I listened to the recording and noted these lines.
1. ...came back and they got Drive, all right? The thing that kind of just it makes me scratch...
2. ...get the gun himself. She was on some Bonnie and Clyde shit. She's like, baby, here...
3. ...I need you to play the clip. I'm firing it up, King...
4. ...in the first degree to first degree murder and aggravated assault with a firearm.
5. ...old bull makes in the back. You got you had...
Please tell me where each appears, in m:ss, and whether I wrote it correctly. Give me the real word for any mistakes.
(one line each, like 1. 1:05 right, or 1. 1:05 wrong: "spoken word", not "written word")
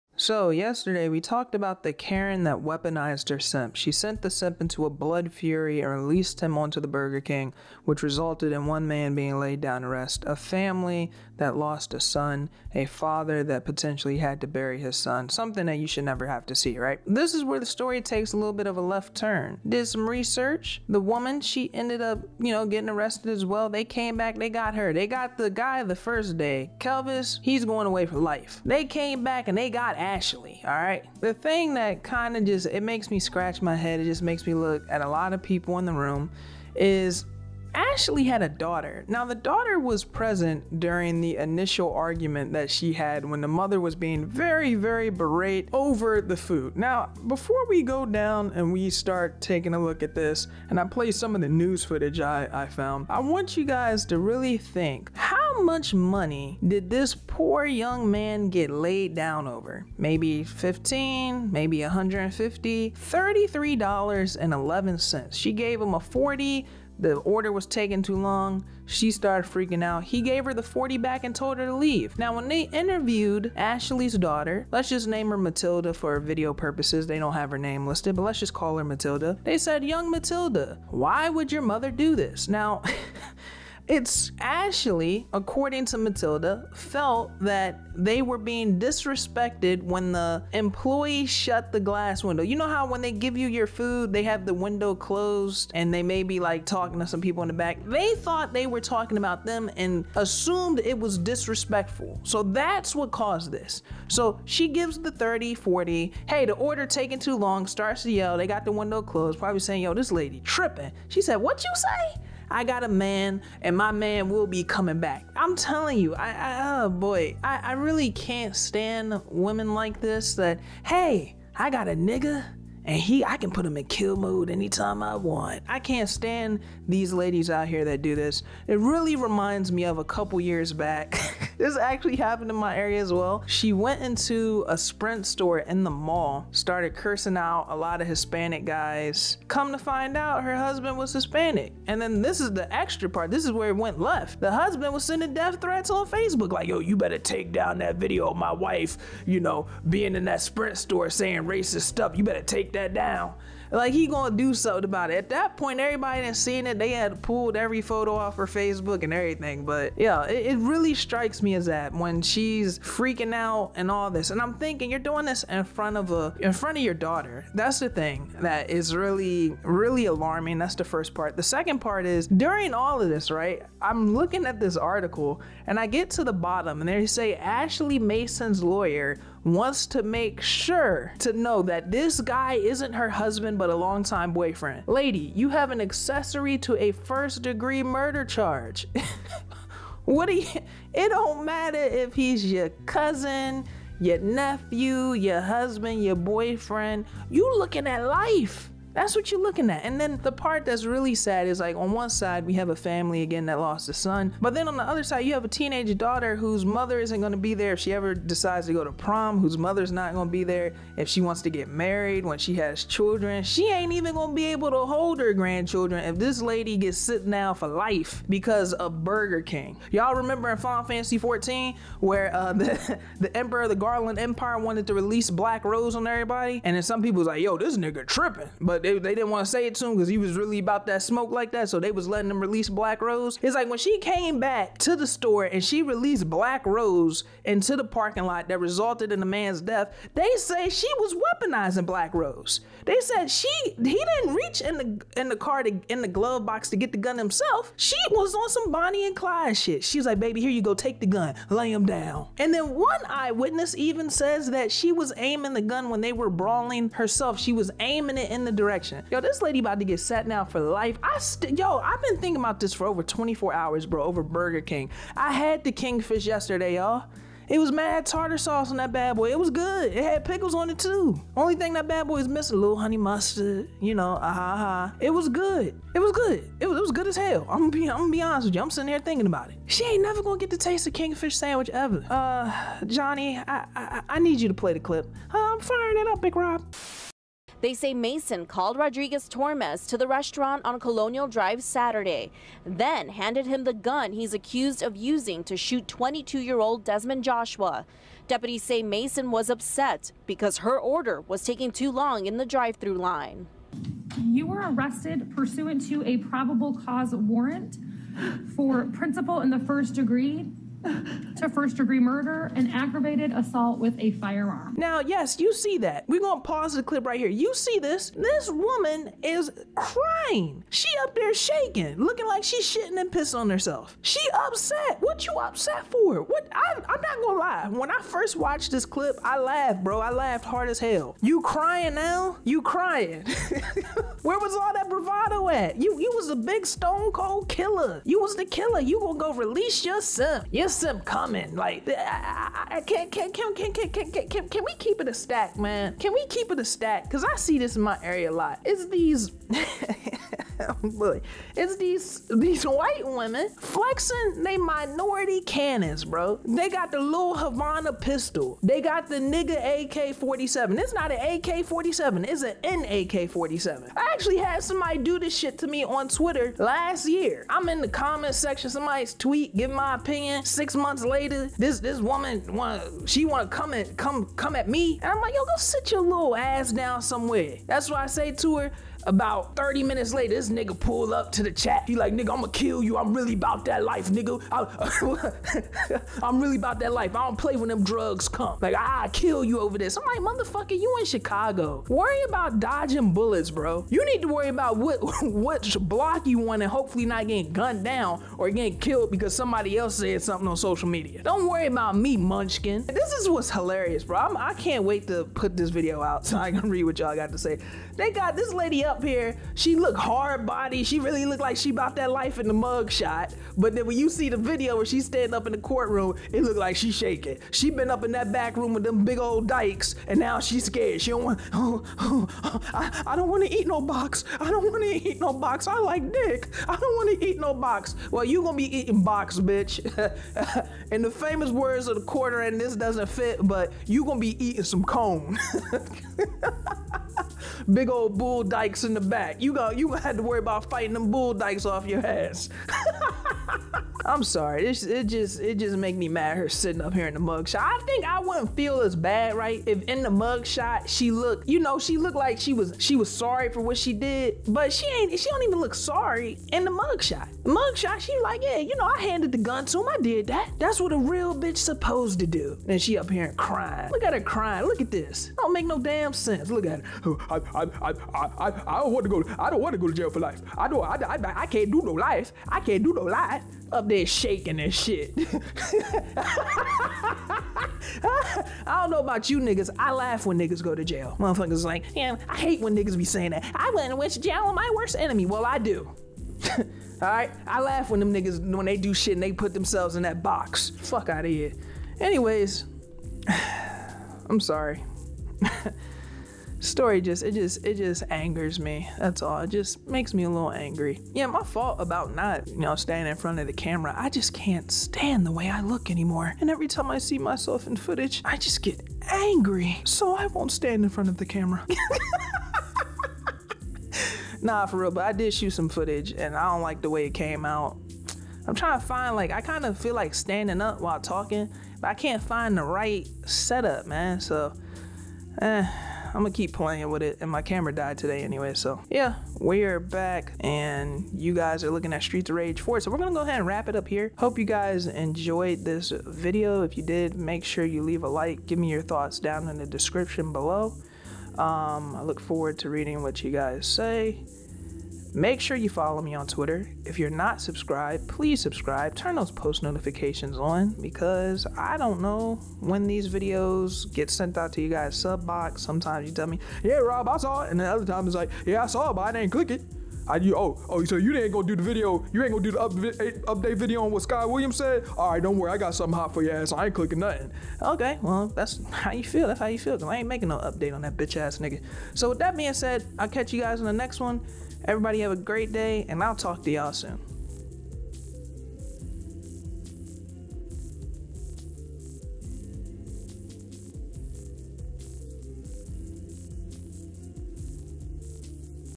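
1. 0:28 wrong: "Ashley", not "Drive"
2. 4:06 right
3. 4:44 wrong: "Big", not "King"
4. 5:09 right
5. 7:17 wrong: "dykes", not "makes".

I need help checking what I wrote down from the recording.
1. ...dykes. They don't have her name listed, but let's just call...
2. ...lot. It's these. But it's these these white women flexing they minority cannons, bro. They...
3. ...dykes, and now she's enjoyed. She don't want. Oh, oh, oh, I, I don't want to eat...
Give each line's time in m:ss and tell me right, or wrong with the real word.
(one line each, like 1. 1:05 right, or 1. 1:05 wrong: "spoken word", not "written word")
1. 1:16 wrong: "purposes", not "dykes"
2. 5:48 right
3. 6:59 wrong: "scared", not "enjoyed".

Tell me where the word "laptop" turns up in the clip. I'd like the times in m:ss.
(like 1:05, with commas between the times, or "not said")
not said.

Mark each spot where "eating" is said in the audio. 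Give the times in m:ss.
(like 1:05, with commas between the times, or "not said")
7:08, 7:14.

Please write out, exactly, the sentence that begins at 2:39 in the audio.
But yeah, it, it really strikes me as that when she's freaking out and all this.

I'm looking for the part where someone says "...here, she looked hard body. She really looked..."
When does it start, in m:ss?
6:49.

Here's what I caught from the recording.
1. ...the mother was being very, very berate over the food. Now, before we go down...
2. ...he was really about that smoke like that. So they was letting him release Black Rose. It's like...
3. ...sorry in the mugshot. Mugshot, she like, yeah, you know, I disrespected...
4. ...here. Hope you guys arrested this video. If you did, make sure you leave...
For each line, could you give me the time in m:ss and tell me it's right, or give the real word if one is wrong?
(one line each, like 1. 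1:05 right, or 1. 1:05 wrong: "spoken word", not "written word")
1. 0:43 right
2. 3:50 right
3. 7:35 wrong: "handed", not "disrespected"
4. 8:53 wrong: "enjoyed", not "arrested".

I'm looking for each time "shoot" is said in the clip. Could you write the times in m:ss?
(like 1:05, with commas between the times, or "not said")
4:55, 8:35.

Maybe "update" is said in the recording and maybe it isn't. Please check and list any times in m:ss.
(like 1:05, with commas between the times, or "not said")
9:23, 9:30.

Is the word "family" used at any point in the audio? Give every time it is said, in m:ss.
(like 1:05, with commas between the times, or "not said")
0:10, 3:22.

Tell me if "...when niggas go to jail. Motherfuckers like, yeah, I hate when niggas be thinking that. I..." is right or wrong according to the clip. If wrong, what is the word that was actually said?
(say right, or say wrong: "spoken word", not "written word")
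wrong: "saying", not "thinking".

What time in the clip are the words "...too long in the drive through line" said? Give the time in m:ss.
5:01.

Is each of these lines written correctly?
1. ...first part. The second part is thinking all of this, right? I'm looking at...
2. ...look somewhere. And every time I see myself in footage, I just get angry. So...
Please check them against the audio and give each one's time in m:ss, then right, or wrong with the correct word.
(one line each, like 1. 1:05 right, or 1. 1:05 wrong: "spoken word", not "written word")
1. 2:50 wrong: "during", not "thinking"
2. 8:25 wrong: "anymore", not "somewhere".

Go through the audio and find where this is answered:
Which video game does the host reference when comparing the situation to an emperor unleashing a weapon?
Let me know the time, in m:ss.
3:40.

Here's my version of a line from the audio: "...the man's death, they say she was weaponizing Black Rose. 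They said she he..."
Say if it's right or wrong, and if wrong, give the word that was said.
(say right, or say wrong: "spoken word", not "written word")
right.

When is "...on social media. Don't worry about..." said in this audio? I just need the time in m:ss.
6:40.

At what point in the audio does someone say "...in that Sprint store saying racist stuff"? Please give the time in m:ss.
2:30.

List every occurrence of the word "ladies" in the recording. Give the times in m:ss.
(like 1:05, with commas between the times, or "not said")
2:07.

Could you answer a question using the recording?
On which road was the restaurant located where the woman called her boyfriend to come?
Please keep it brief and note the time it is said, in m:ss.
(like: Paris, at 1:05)
Colonial Drive, at 4:50.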